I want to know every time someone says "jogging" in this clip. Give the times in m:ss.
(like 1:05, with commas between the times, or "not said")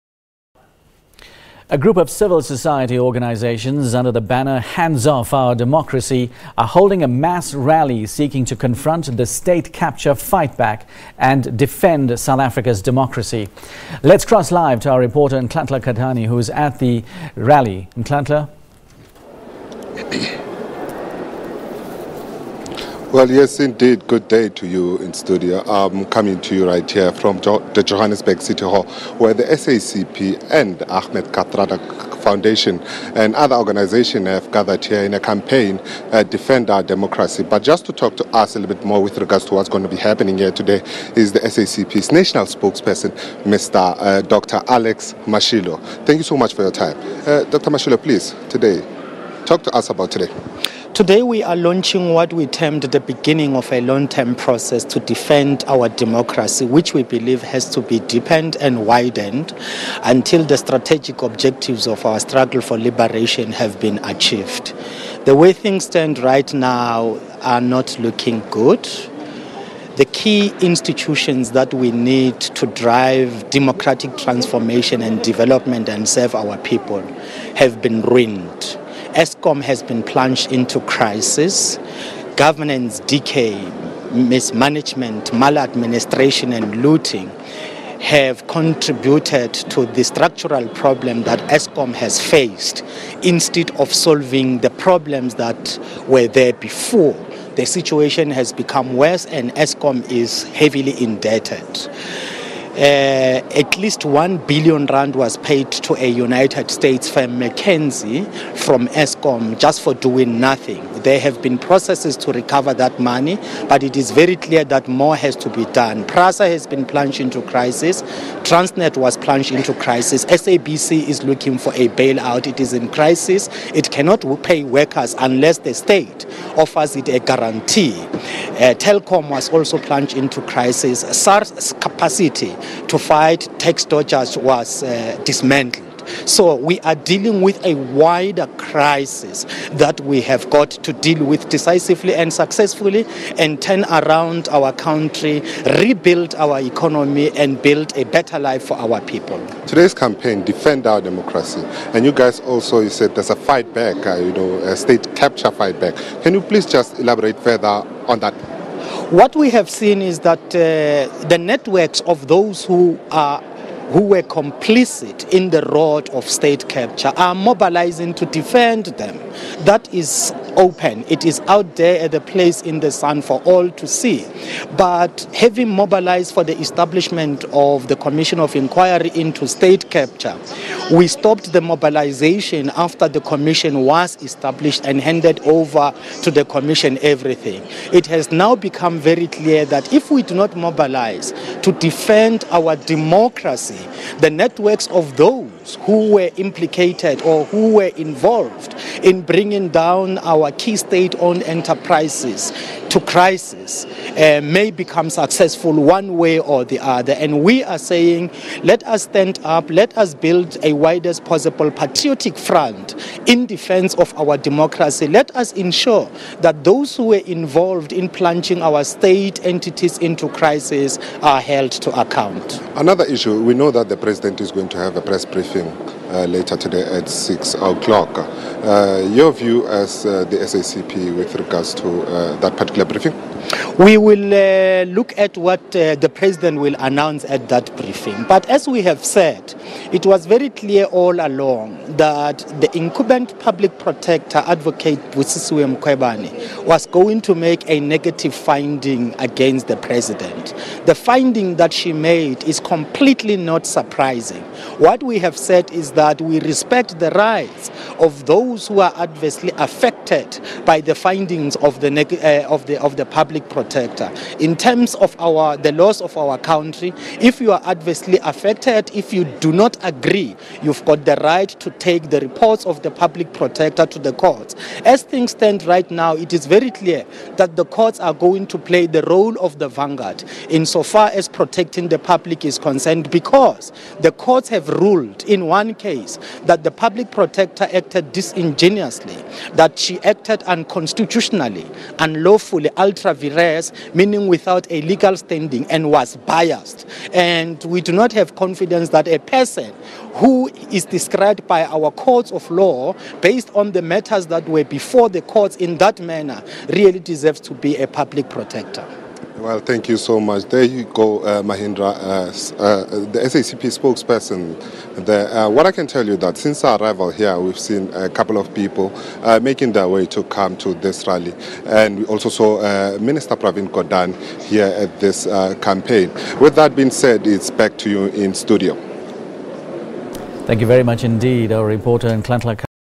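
not said.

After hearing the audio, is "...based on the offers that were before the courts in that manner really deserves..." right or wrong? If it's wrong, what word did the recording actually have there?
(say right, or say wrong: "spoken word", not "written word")
wrong: "matters", not "offers".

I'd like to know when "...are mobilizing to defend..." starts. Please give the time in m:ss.
2:47.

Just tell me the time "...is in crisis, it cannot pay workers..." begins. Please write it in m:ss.
2:02.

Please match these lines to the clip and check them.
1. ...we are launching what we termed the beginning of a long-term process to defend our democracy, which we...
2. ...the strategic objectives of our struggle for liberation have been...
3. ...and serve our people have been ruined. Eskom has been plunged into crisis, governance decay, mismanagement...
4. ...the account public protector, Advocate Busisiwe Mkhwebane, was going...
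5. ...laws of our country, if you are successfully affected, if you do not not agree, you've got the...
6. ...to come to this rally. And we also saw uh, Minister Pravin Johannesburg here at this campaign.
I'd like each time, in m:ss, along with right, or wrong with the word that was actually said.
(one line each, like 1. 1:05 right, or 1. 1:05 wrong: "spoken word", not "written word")
1. 0:51 right
2. 1:00 right
3. 1:15 right
4. 4:02 wrong: "incumbent", not "account"
5. 4:25 wrong: "adversely", not "successfully"
6. 5:20 wrong: "Gordhan", not "Johannesburg".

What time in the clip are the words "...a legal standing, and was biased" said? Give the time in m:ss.
4:54.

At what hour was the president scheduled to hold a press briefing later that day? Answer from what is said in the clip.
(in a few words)
6 o'clock.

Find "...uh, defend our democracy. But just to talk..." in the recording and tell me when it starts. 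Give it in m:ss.
0:36.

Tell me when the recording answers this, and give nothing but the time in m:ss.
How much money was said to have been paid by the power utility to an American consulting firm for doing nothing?
1:44.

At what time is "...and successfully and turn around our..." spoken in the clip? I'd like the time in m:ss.
2:22.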